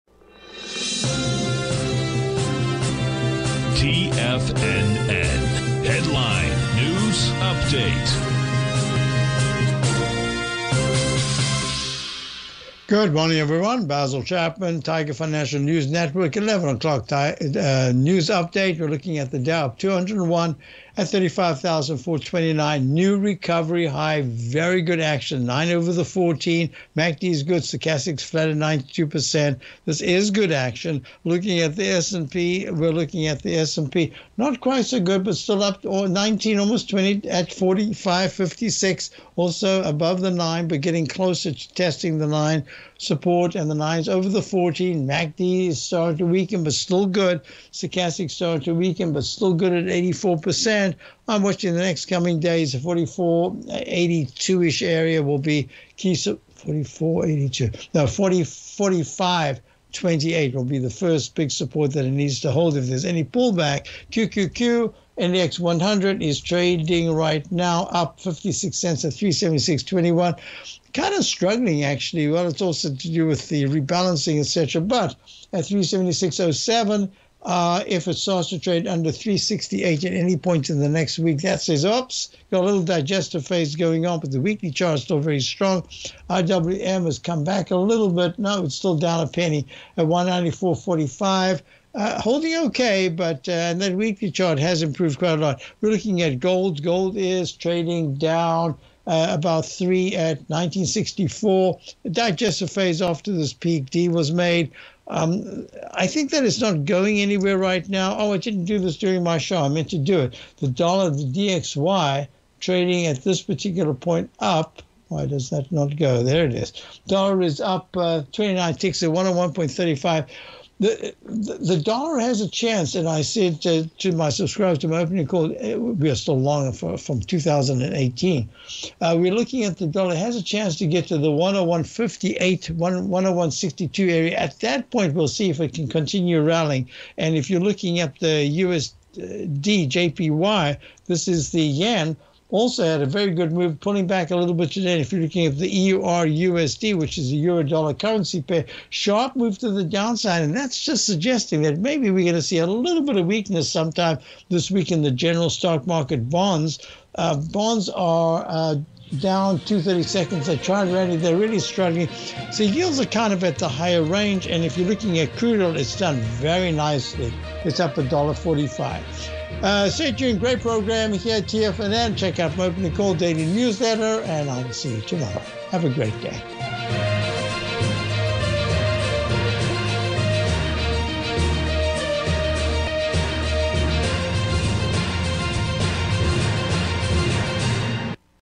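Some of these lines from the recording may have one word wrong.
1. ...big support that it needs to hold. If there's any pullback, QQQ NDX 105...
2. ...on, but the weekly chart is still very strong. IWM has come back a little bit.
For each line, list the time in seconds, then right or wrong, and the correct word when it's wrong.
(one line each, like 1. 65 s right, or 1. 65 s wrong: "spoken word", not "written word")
1. 61 s wrong: "100", not "105"
2. 84 s right.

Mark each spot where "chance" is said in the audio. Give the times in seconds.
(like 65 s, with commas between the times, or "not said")
122 s, 130 s.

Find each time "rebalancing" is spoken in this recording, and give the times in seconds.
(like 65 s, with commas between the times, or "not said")
73 s.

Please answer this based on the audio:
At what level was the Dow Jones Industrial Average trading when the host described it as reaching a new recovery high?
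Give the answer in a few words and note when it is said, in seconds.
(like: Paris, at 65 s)
35,429, at 21 s.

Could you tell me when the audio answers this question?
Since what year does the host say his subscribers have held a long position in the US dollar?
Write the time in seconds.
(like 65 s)
127 s.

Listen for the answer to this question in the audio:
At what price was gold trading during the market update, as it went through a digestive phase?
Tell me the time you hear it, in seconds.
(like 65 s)
100 s.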